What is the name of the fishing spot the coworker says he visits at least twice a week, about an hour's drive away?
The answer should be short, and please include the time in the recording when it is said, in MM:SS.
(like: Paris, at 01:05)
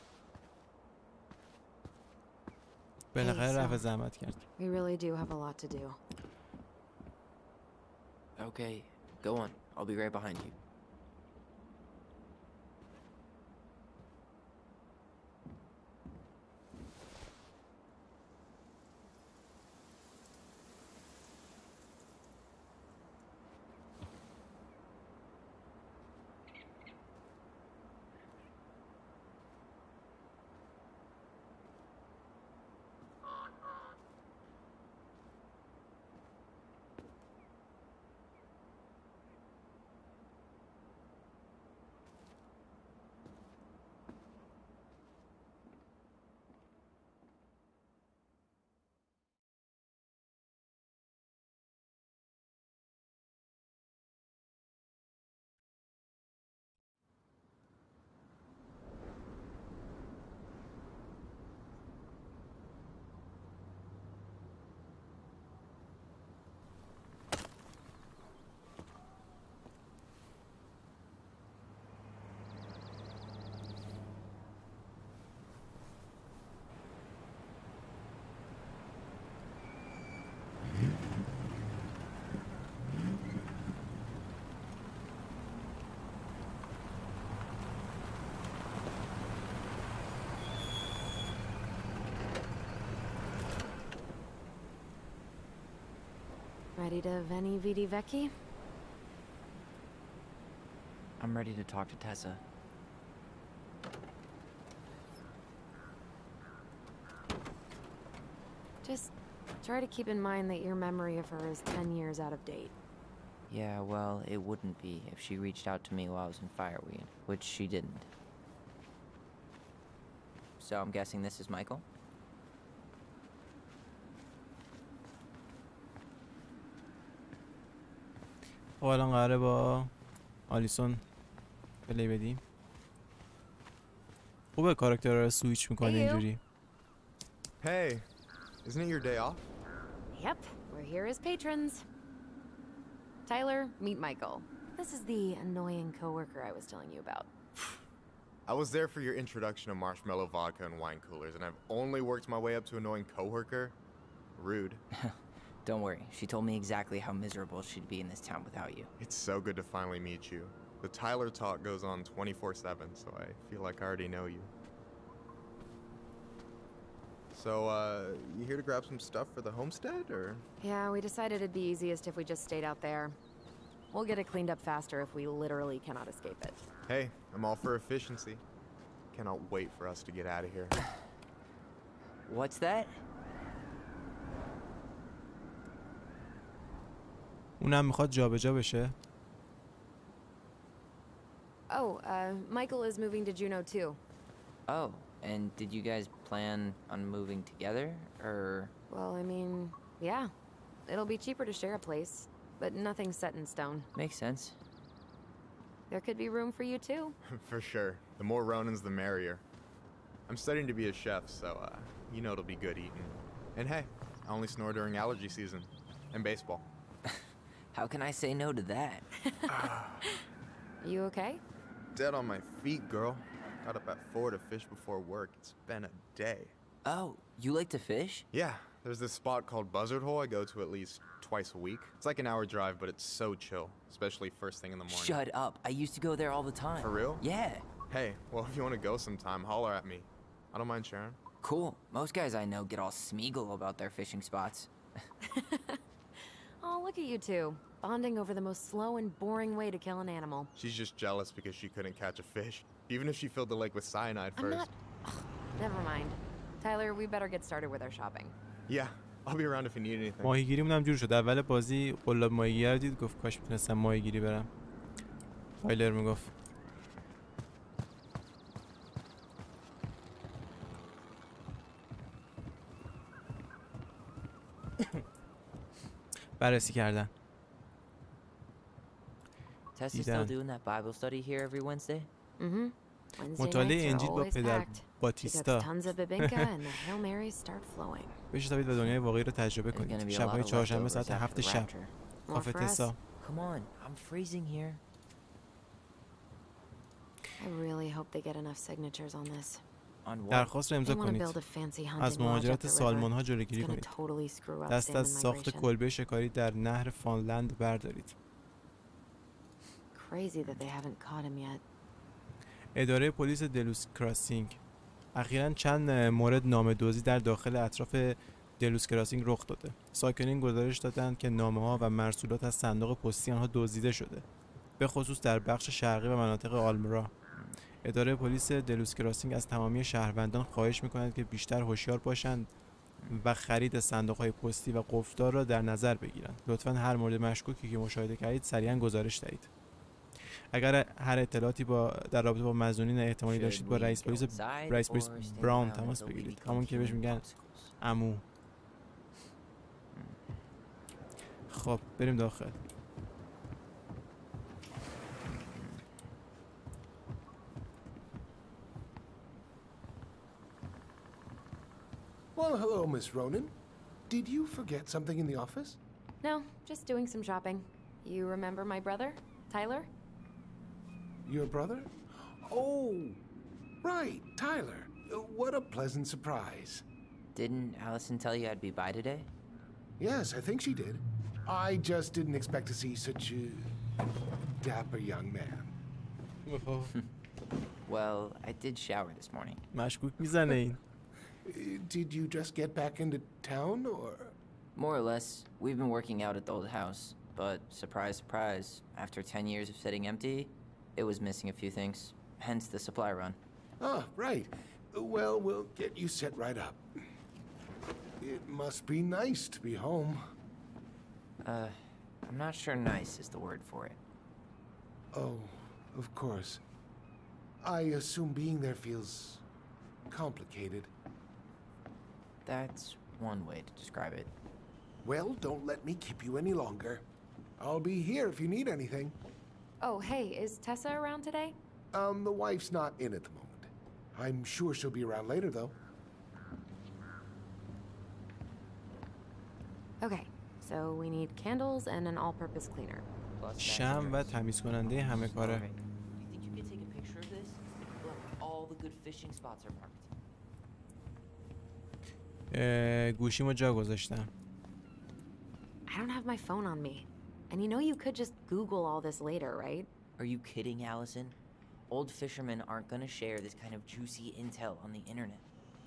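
Buzzard Hole, at 03:49.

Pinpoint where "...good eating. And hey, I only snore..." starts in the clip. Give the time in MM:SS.
03:32.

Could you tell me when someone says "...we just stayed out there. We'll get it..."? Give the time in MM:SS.
02:52.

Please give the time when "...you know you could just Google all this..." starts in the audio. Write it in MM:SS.
07:37.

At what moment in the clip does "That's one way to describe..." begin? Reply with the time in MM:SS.
07:02.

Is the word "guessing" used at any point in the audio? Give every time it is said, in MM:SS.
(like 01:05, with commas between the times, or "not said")
02:00.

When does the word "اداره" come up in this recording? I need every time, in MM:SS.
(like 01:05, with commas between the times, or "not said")
05:12, 05:27.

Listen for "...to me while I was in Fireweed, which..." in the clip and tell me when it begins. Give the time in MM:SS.
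01:55.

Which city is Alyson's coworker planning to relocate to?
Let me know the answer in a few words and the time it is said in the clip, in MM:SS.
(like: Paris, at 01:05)
Juneau, at 03:13.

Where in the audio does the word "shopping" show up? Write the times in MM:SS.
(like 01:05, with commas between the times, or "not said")
04:17, 06:07.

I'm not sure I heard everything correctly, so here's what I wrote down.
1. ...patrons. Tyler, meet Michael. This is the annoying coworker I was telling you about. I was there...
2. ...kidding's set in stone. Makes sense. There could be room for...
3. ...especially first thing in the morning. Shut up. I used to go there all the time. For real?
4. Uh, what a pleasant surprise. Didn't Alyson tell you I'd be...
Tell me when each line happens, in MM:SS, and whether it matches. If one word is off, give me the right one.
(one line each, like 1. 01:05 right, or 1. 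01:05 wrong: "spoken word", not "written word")
1. 02:21 right
2. 03:22 wrong: "nothing", not "kidding"
3. 03:53 right
4. 06:15 right.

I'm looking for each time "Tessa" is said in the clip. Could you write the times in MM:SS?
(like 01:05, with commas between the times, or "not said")
01:41, 07:10.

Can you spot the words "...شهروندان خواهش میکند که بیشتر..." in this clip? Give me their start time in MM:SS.
05:29.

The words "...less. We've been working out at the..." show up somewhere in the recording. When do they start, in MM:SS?
06:35.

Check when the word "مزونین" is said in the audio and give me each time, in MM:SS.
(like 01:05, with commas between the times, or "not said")
05:42.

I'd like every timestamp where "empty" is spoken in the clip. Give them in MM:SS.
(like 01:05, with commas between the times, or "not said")
06:40.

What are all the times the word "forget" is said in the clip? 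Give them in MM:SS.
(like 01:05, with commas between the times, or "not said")
06:04.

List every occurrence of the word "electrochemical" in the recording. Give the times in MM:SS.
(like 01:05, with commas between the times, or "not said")
not said.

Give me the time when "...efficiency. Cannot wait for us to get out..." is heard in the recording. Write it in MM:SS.
02:57.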